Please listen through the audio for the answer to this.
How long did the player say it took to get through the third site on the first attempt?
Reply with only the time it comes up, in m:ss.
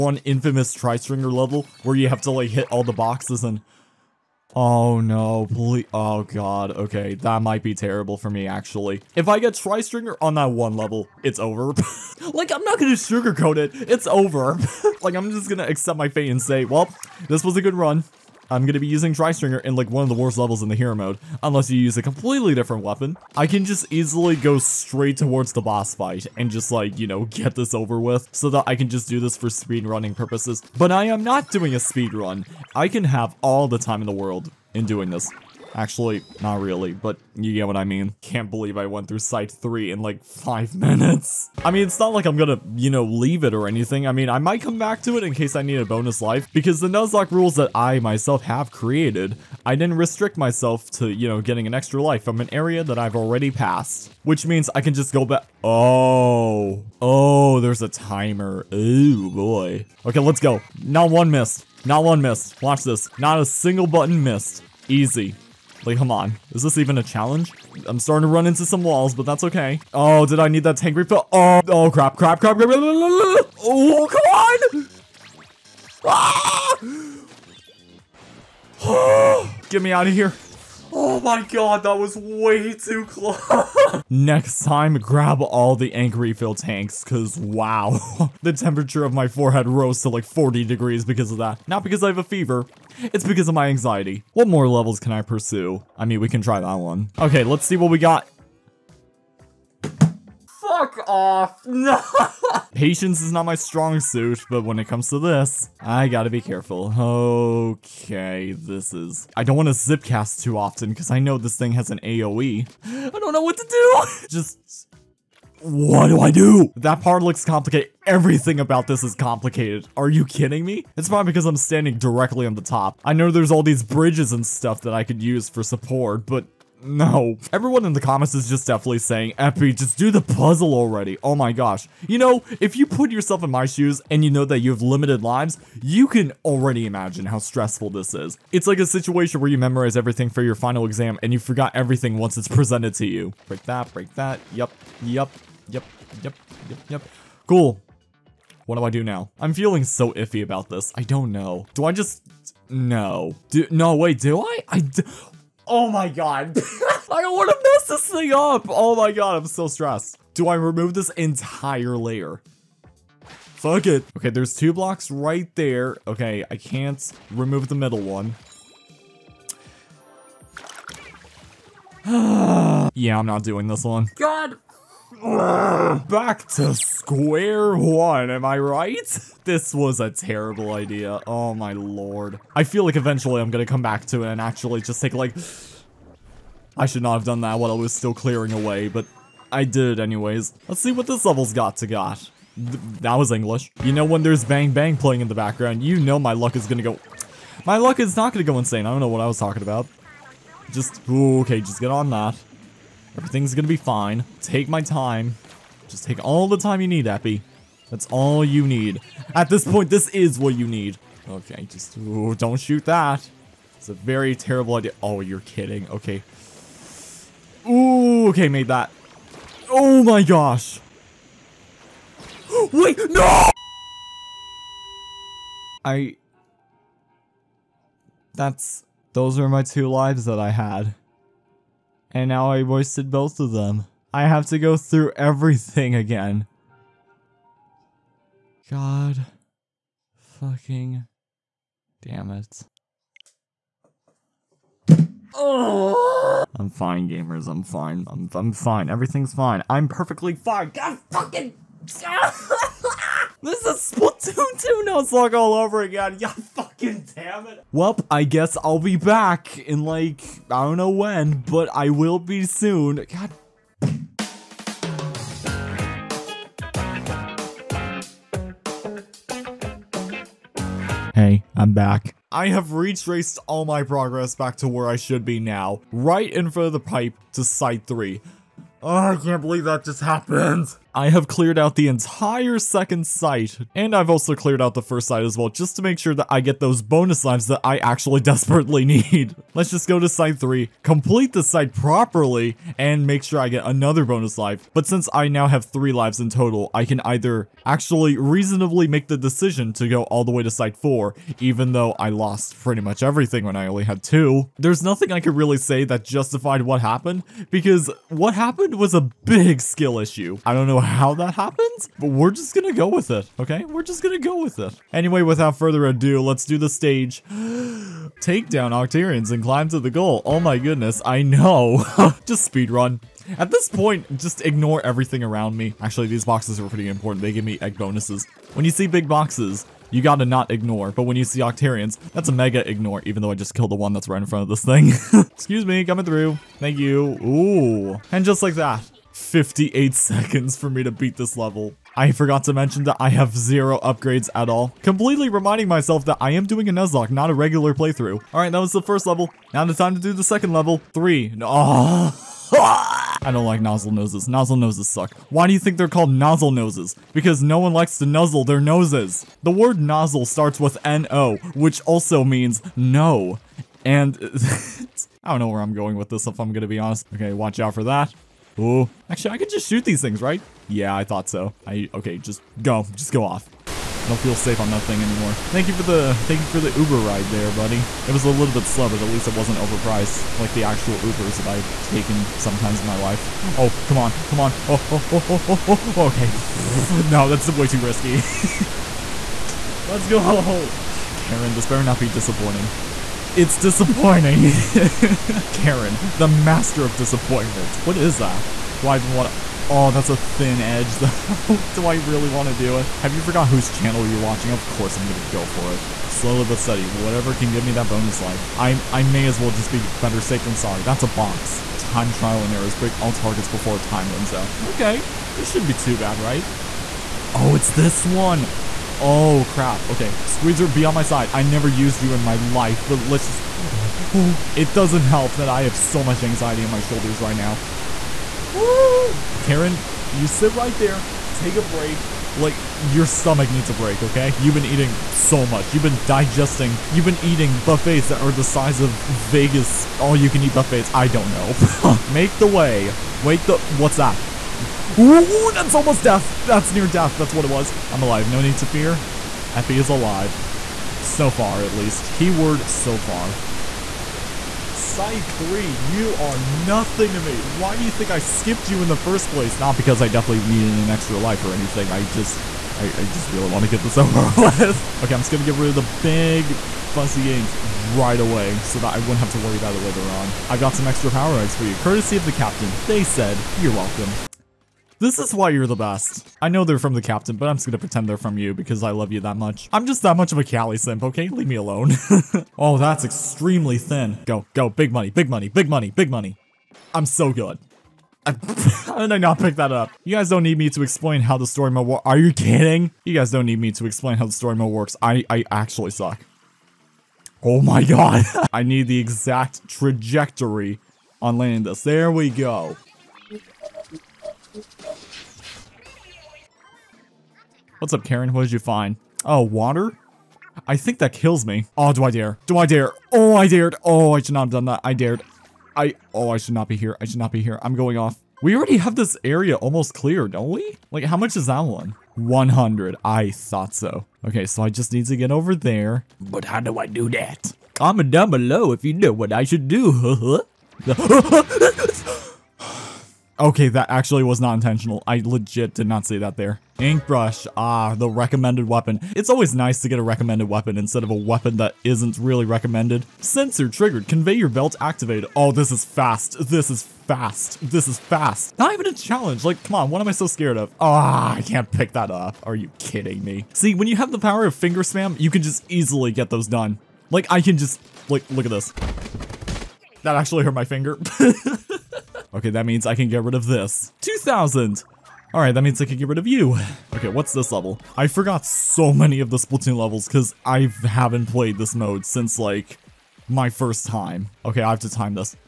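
0:40.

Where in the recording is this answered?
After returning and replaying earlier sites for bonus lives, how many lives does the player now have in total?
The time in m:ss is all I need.
4:55.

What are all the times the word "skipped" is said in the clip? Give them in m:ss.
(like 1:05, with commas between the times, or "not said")
7:38.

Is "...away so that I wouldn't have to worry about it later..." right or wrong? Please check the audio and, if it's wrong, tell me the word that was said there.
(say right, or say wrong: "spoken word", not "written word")
right.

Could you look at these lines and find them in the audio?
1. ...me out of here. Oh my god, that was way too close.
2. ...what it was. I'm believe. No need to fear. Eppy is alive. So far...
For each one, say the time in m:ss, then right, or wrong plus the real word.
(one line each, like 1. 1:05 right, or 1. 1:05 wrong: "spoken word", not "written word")
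1. 1:19 right
2. 7:27 wrong: "alive", not "believe".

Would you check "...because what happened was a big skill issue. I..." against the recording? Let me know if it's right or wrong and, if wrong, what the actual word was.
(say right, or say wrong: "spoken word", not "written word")
right.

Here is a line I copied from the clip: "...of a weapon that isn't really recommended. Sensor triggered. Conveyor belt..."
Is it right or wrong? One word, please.
right.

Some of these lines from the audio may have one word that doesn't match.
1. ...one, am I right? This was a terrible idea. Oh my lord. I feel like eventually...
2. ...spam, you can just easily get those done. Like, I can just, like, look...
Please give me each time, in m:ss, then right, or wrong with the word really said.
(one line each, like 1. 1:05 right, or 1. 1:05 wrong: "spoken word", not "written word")
1. 2:57 right
2. 9:14 right.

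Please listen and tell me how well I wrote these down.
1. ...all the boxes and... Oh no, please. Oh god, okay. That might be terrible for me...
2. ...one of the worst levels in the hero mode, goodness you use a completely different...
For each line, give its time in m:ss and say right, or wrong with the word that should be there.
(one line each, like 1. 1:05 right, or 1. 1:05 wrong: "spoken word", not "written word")
1. 0:02 right
2. 0:19 wrong: "unless", not "goodness".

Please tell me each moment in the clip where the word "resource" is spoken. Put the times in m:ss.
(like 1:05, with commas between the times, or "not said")
not said.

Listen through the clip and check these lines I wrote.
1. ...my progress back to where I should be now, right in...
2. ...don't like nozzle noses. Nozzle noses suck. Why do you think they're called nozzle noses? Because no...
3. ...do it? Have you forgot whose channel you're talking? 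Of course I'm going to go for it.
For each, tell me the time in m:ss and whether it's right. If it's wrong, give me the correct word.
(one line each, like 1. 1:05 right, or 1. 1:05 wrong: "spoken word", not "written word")
1. 4:33 right
2. 5:53 right
3. 6:42 wrong: "watching", not "talking".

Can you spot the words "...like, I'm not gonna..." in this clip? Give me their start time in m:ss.
0:12.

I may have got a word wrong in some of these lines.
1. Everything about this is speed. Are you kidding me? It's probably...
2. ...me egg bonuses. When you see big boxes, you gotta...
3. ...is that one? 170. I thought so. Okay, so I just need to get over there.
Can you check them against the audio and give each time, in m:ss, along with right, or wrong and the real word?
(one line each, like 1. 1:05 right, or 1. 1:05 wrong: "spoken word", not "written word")
1. 1:58 wrong: "complicated", not "speed"
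2. 5:27 right
3. 8:41 wrong: "100", not "170".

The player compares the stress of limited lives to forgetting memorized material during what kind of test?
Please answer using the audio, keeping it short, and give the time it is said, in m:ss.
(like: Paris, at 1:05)
final exam, at 2:20.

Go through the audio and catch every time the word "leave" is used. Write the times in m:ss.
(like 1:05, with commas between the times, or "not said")
0:43, 8:01.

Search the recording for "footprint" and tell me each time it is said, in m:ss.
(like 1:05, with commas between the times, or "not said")
not said.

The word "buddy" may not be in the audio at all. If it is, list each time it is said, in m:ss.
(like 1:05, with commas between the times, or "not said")
6:17.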